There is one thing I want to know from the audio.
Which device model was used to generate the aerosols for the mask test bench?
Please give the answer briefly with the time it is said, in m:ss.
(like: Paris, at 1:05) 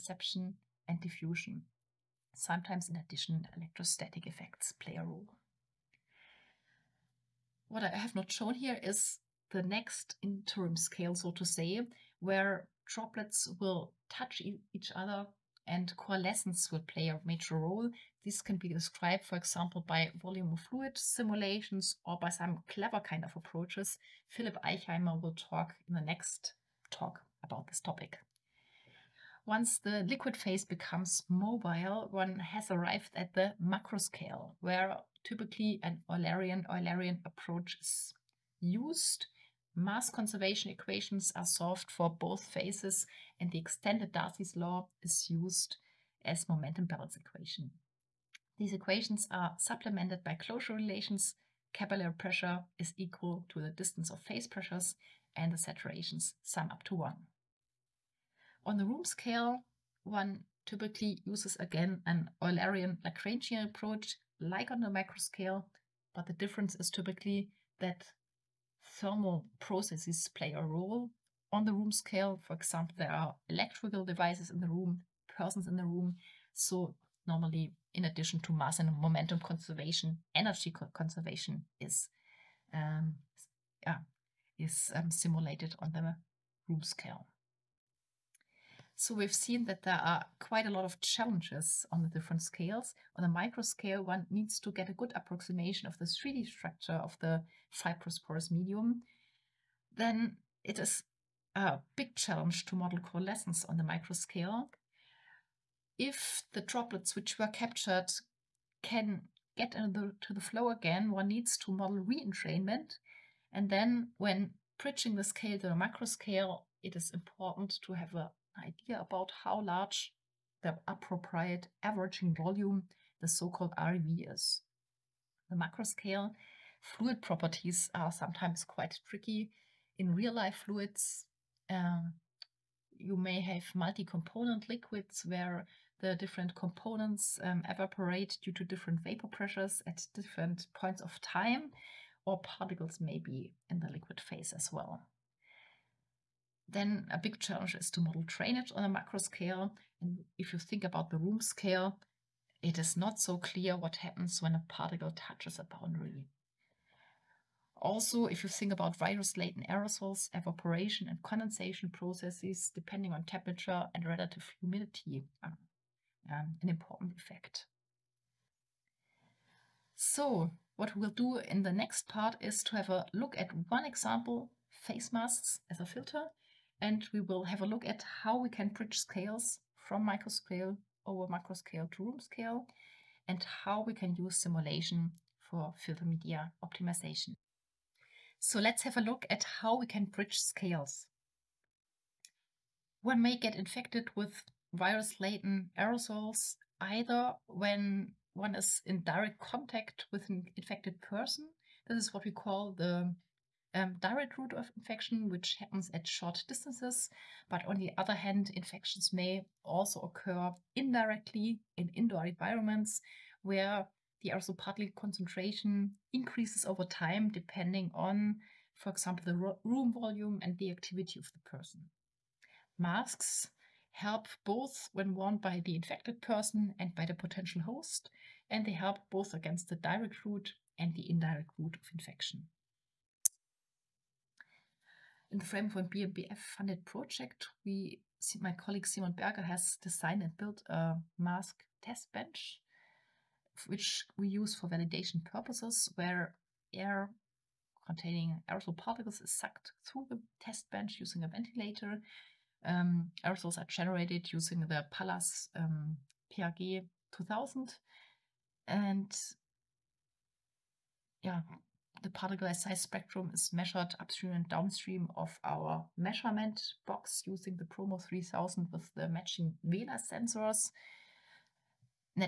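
Palas PRG 2000, at 4:14.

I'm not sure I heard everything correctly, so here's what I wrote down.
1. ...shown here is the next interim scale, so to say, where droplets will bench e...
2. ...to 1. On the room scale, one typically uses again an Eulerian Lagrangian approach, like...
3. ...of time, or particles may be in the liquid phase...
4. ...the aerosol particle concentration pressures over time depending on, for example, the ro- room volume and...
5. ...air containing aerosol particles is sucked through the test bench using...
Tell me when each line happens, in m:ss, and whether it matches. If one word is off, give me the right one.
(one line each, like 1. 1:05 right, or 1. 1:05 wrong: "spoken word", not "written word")
1. 0:08 wrong: "touch", not "bench"
2. 0:56 right
3. 2:21 right
4. 3:34 wrong: "increases", not "pressures"
5. 4:06 right.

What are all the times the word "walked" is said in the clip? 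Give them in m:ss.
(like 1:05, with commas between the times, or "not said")
not said.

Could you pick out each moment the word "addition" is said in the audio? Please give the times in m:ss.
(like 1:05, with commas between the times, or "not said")
0:02, 1:18.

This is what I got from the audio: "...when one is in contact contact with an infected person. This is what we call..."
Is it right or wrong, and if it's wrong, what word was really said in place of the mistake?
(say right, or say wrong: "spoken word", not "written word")
wrong: "direct", not "contact".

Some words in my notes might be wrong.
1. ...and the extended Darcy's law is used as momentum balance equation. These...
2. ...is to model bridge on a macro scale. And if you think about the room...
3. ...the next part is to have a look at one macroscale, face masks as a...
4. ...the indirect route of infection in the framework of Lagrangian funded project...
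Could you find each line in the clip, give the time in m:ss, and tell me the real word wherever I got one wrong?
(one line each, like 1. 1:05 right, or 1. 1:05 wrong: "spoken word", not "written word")
1. 0:43 right
2. 2:27 wrong: "drainage", not "bridge"
3. 2:51 wrong: "example", not "macroscale"
4. 3:50 wrong: "BMBF", not "Lagrangian".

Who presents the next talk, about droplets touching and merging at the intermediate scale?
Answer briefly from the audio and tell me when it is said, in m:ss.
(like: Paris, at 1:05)
Philip Eichheimer, at 0:24.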